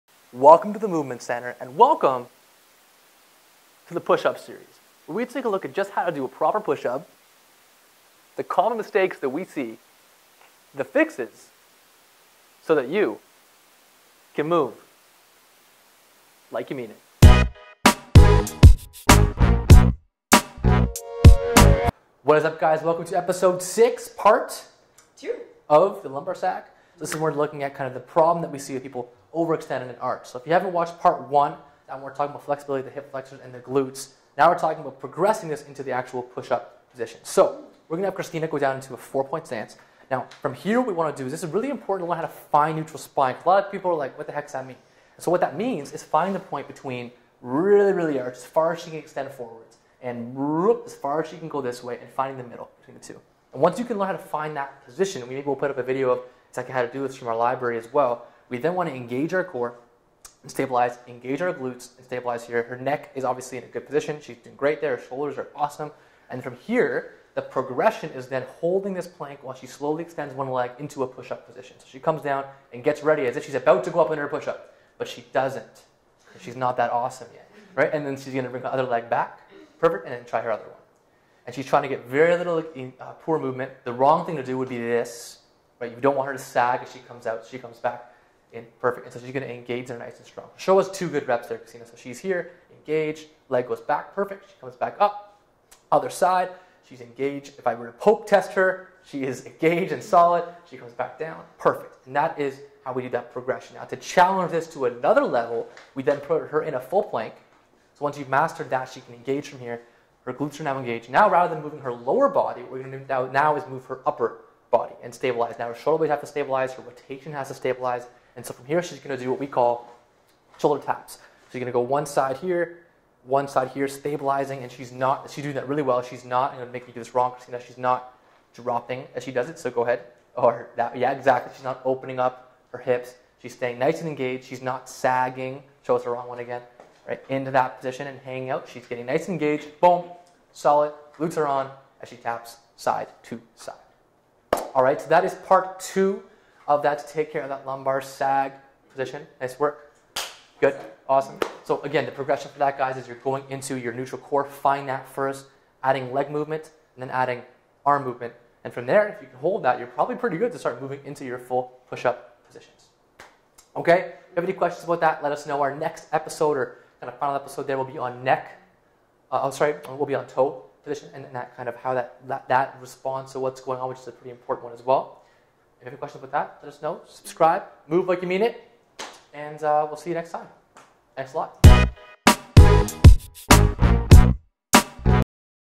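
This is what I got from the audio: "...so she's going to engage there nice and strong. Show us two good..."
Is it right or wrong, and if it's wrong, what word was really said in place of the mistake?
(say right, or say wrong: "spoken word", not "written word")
right.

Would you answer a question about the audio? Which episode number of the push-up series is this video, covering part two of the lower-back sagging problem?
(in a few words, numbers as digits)
6.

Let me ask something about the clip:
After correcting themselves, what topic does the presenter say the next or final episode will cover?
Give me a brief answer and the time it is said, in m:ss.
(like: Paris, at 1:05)
Toe position, at 2:50.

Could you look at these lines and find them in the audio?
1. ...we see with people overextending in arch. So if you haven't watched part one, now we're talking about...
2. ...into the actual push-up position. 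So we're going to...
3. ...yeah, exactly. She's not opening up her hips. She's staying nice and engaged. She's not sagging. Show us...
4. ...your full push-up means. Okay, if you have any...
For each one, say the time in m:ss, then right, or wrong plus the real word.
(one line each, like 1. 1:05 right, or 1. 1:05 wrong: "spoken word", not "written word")
1. 0:28 right
2. 0:35 right
3. 2:10 right
4. 2:41 wrong: "positions", not "means".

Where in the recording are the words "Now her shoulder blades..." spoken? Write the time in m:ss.
1:55.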